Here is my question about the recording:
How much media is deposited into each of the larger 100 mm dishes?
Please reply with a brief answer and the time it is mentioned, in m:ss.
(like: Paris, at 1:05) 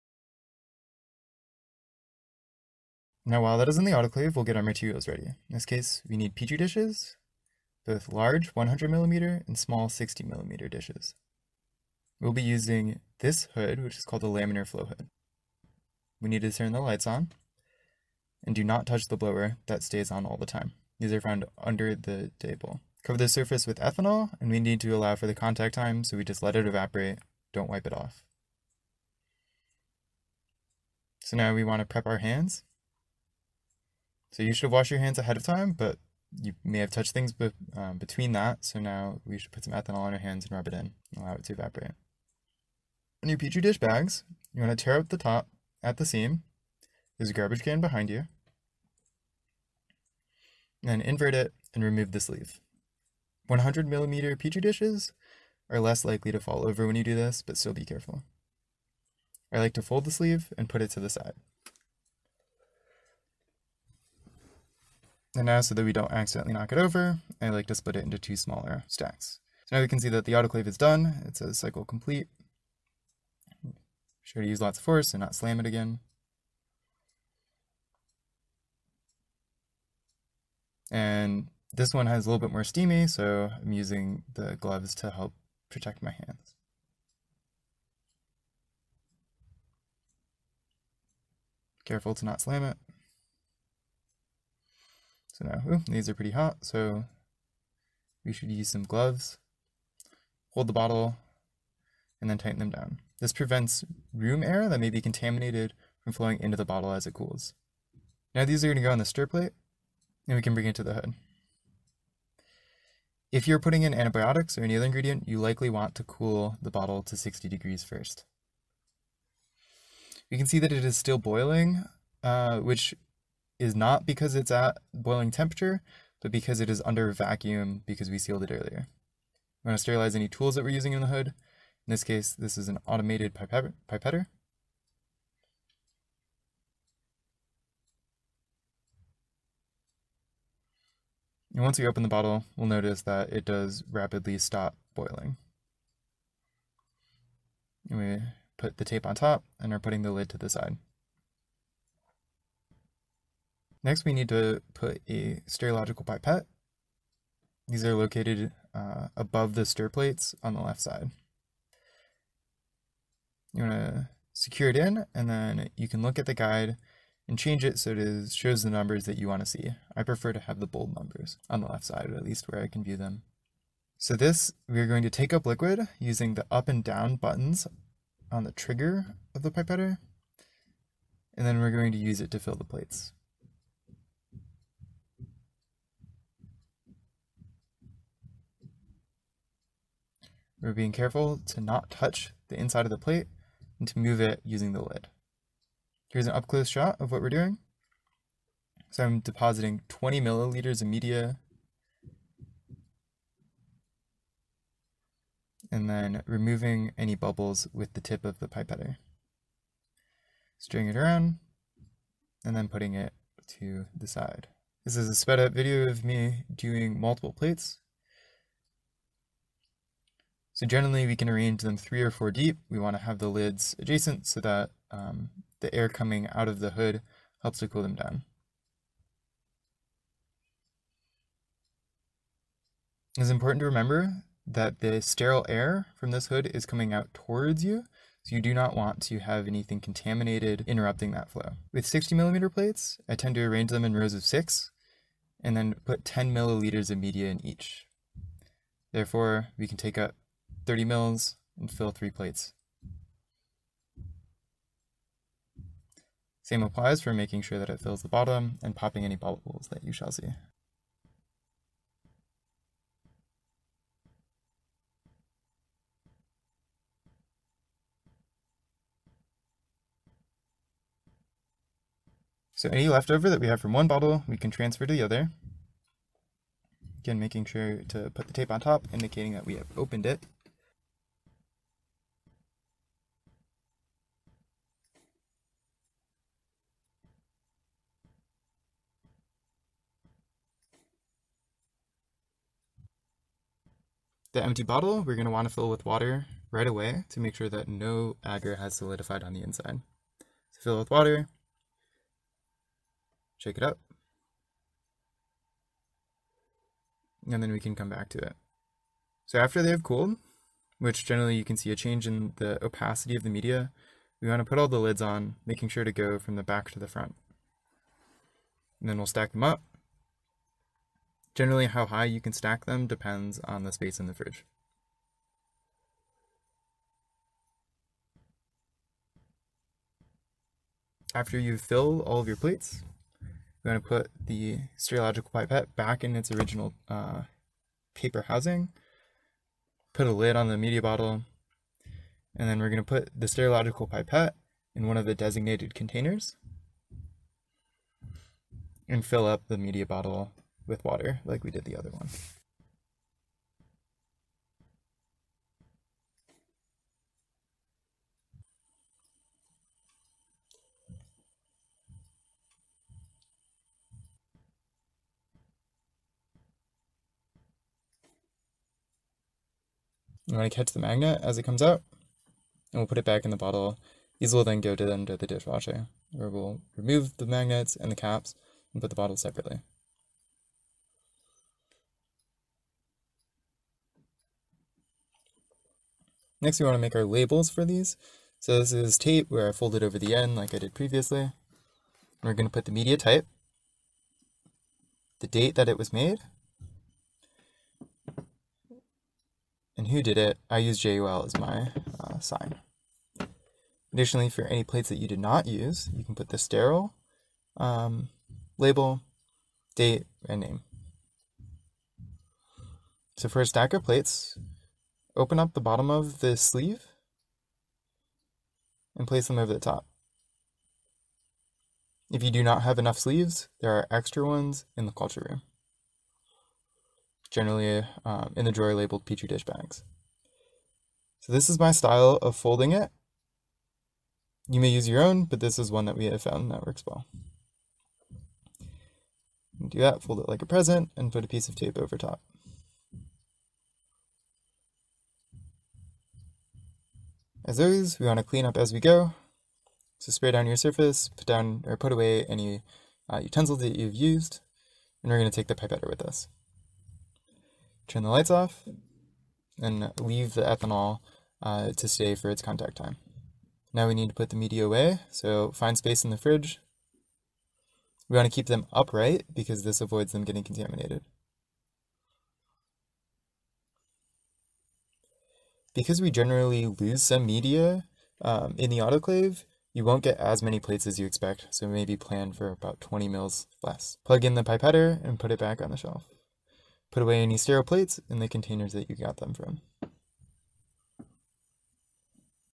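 20 milliliters, at 3:19.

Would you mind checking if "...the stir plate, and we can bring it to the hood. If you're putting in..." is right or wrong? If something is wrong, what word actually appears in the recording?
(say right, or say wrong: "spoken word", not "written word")
right.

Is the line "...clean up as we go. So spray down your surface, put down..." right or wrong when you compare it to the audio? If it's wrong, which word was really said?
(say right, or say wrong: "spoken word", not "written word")
right.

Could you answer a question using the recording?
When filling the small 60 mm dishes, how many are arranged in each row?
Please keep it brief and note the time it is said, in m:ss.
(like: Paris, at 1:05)
six, at 4:03.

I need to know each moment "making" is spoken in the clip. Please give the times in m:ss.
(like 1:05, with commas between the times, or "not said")
4:17, 4:37, 5:15.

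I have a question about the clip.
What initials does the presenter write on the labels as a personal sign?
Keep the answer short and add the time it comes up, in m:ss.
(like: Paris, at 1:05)
JUL, at 6:40.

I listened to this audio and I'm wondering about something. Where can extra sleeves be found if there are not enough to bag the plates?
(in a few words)
the culture room.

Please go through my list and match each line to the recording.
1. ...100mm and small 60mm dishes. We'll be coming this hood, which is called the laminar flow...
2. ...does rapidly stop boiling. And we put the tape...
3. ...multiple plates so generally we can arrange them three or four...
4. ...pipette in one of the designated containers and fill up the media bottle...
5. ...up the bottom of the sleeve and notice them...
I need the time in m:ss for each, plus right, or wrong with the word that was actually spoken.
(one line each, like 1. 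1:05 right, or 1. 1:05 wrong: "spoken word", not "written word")
1. 0:08 wrong: "using", not "coming"
2. 2:23 right
3. 3:36 right
4. 5:43 right
5. 6:55 wrong: "place", not "notice".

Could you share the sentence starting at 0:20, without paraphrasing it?
These are found under the table.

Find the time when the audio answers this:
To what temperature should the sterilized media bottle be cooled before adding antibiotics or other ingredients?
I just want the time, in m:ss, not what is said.
1:57.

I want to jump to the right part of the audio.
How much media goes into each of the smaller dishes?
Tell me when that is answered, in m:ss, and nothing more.
4:06.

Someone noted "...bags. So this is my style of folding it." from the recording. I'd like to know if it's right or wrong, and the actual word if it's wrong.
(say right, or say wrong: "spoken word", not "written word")
right.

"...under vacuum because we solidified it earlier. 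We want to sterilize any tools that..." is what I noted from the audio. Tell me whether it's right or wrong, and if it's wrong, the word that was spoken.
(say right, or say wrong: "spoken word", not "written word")
wrong: "sealed", not "solidified".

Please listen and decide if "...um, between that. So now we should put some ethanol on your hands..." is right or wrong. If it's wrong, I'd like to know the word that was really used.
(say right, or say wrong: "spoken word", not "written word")
right.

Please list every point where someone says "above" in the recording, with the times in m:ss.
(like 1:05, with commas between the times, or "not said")
2:39.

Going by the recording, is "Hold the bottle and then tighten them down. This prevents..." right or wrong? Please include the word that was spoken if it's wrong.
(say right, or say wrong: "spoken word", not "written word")
right.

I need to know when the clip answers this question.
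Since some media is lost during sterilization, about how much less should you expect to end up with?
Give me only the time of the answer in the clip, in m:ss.
8:02.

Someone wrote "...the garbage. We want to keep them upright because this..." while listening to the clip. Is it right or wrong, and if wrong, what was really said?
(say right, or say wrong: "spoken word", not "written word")
wrong: "fridge", not "garbage".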